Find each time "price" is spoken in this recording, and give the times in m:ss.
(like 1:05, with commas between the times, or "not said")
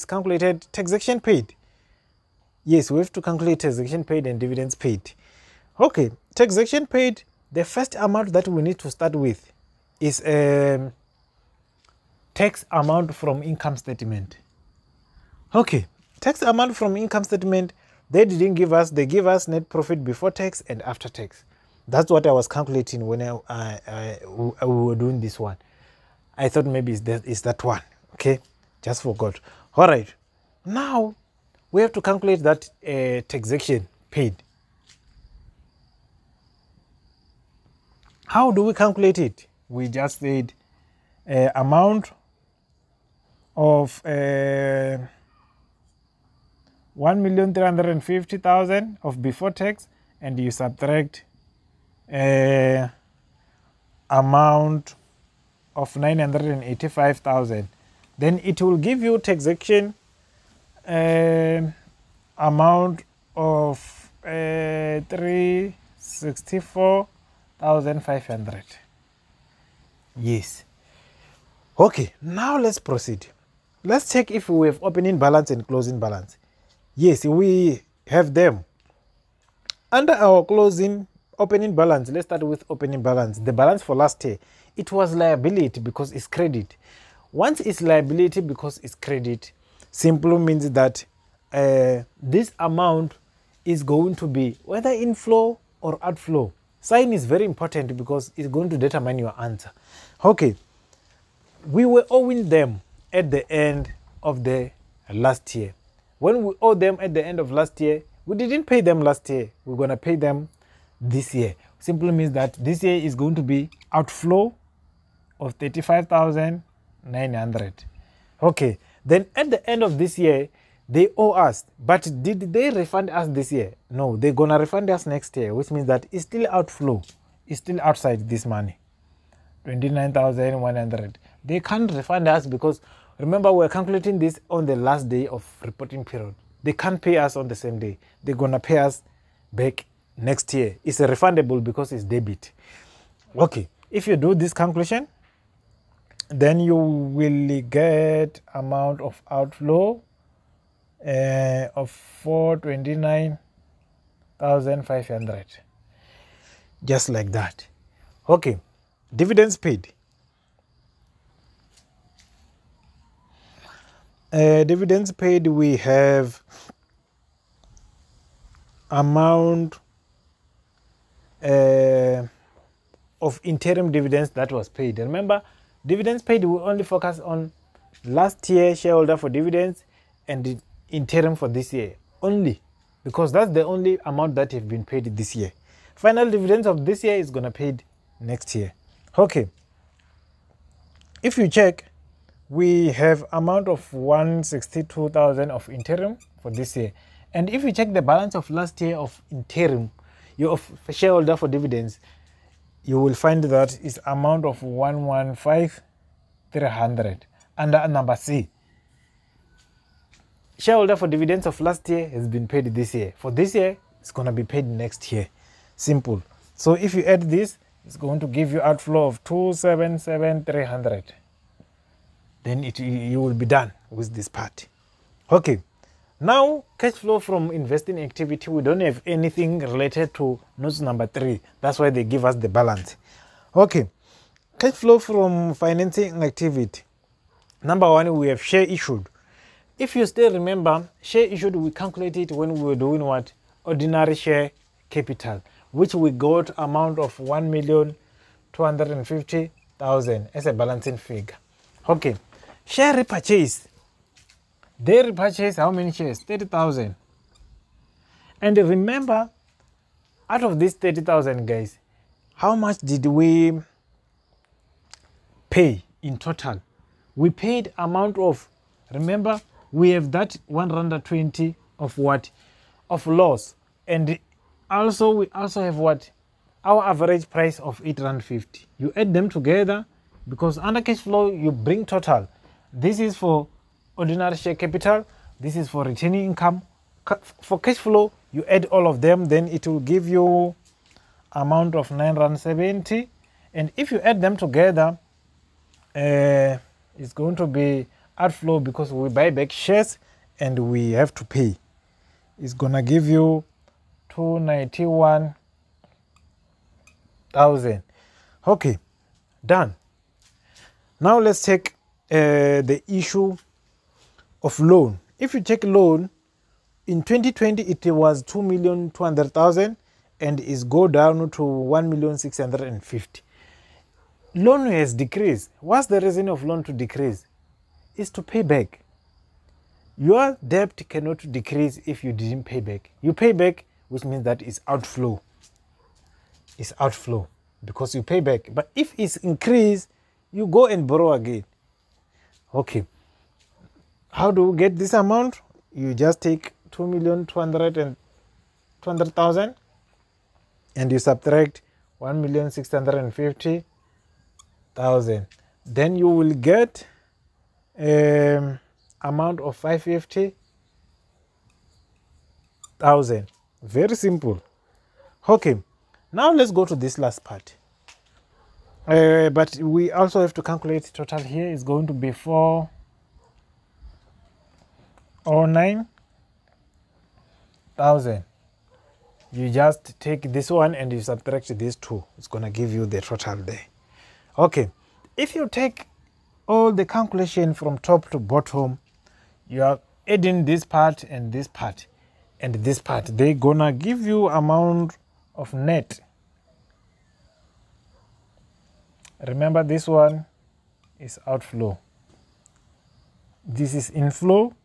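4:37.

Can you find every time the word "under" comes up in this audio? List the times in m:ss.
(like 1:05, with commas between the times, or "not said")
1:19, 3:27, 4:40.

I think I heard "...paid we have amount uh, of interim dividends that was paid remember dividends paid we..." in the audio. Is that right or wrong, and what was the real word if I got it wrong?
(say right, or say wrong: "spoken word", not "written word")
right.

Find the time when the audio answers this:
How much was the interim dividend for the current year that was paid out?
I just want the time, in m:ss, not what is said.
3:13.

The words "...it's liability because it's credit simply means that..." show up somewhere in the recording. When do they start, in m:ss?
1:27.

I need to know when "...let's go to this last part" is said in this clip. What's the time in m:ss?
6:06.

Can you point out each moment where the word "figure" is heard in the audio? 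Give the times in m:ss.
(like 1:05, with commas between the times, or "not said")
4:10.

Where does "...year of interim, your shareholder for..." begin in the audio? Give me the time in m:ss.
3:18.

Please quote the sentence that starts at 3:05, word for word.
Final dividends of this year is going to paid next year.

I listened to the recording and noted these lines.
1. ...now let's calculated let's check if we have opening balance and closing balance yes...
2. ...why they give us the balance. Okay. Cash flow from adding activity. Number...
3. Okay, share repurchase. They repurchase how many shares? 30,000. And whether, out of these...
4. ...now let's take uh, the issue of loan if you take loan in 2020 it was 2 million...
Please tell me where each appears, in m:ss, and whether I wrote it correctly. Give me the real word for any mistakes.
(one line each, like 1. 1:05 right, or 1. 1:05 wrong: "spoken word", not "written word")
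1. 1:12 wrong: "proceed", not "calculated"
2. 3:51 wrong: "financing", not "adding"
3. 4:11 wrong: "remember", not "whether"
4. 5:10 right.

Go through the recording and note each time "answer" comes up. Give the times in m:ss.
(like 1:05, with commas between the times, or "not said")
1:39.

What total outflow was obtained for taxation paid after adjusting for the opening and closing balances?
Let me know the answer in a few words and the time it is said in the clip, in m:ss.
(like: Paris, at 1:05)
429,500, at 2:31.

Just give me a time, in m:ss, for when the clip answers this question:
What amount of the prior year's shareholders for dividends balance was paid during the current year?
3:24.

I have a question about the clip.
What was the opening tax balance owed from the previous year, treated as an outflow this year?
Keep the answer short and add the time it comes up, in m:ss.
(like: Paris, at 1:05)
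35,900, at 1:55.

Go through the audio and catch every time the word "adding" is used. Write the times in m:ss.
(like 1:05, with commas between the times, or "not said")
6:30.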